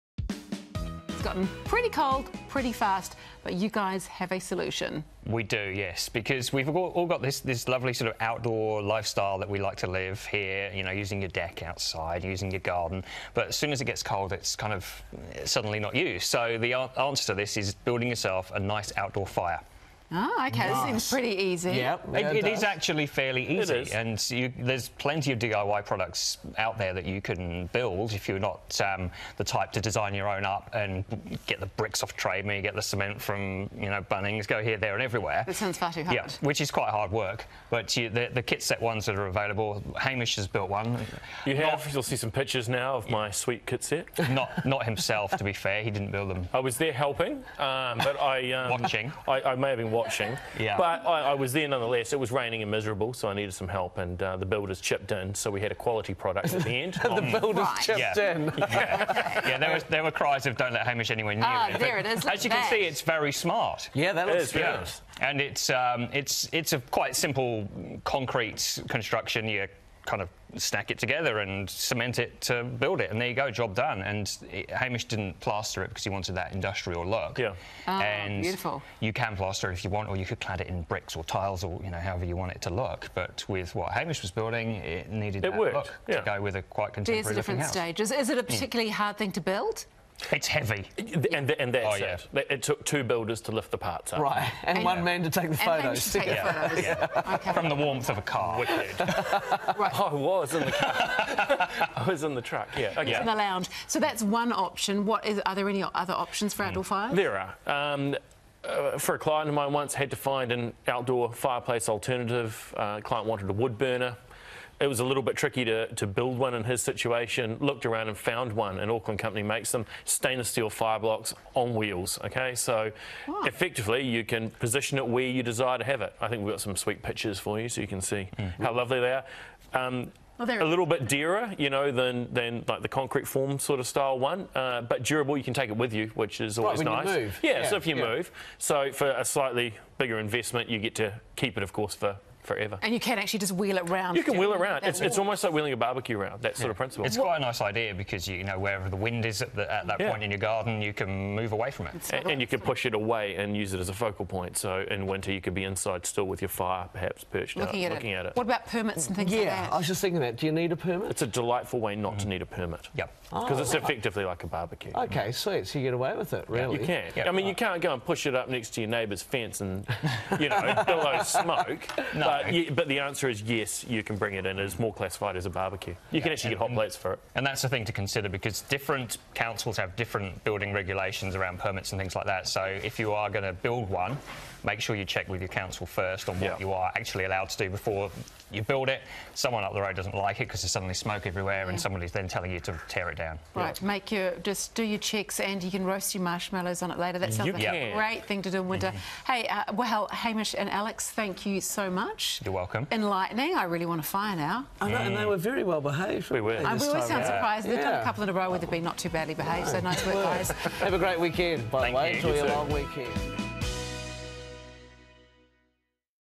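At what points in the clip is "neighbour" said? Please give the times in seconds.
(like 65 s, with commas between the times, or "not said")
168 s.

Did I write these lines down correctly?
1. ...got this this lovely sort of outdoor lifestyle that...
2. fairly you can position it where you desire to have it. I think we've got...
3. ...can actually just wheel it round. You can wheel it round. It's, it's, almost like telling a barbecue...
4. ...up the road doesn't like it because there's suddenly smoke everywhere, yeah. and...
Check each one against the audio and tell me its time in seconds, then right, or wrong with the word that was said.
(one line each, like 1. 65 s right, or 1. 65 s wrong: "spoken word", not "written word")
1. 7 s right
2. 123 s wrong: "effectively", not "fairly"
3. 142 s wrong: "wheeling", not "telling"
4. 189 s right.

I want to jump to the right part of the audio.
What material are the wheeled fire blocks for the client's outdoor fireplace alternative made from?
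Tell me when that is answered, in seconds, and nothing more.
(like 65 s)
120 s.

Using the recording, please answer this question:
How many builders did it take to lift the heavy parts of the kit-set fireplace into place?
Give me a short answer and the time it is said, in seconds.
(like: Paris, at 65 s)
2, at 92 s.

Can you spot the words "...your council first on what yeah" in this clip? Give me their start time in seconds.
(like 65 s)
185 s.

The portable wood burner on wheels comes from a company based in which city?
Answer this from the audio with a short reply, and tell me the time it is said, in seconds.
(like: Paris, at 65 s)
Auckland, at 118 s.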